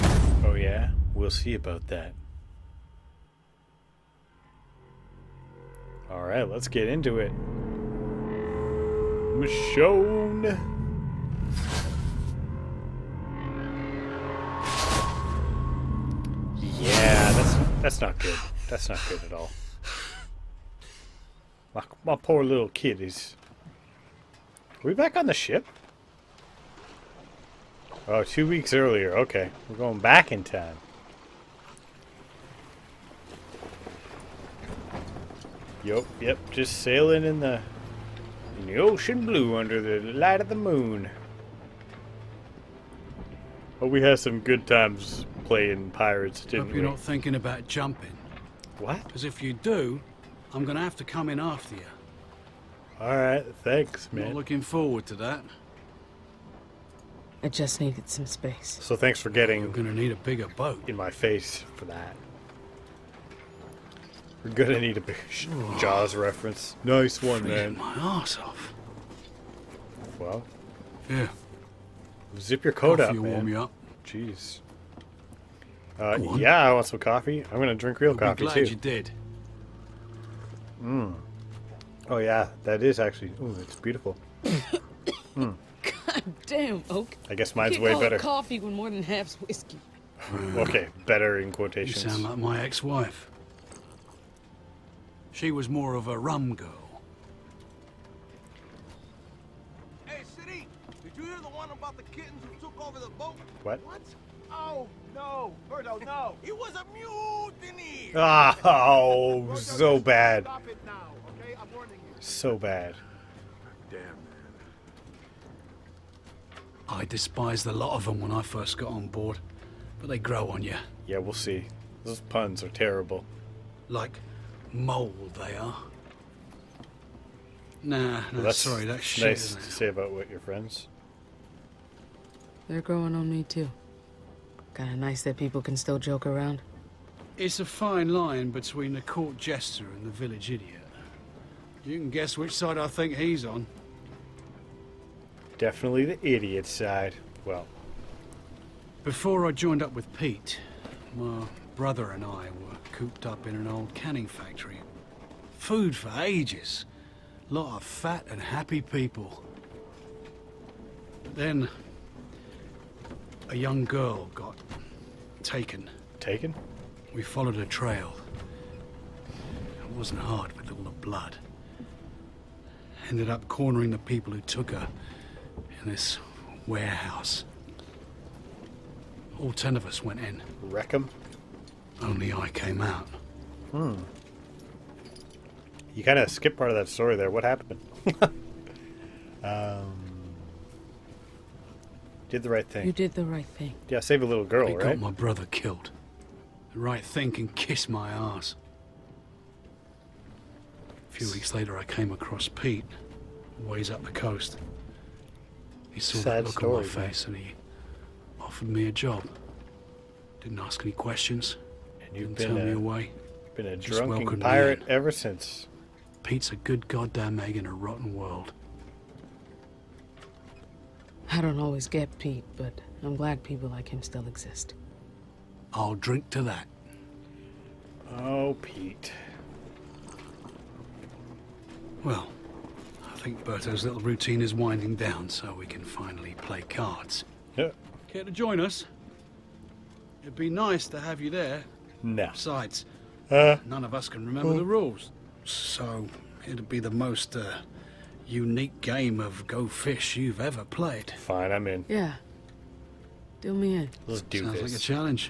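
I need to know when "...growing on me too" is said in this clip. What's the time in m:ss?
2:12.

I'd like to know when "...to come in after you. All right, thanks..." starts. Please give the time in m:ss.
0:50.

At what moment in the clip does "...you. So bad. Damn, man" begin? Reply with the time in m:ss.
1:52.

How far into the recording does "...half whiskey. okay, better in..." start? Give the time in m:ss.
1:29.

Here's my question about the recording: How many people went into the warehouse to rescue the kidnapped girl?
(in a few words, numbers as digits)
10.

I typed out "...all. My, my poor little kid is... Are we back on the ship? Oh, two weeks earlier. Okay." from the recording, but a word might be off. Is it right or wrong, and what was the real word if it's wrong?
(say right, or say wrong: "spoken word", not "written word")
right.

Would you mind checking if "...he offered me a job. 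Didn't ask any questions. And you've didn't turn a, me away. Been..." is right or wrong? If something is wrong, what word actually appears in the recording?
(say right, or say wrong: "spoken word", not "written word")
right.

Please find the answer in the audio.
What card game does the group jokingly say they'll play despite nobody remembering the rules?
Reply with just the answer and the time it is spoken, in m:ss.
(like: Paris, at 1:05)
go fish, at 4:09.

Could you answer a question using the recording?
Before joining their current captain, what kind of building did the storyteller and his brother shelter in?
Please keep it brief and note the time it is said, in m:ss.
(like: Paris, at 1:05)
an old canning factory, at 2:33.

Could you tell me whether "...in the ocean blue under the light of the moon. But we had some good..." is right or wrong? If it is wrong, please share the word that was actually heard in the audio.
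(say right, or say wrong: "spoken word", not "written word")
right.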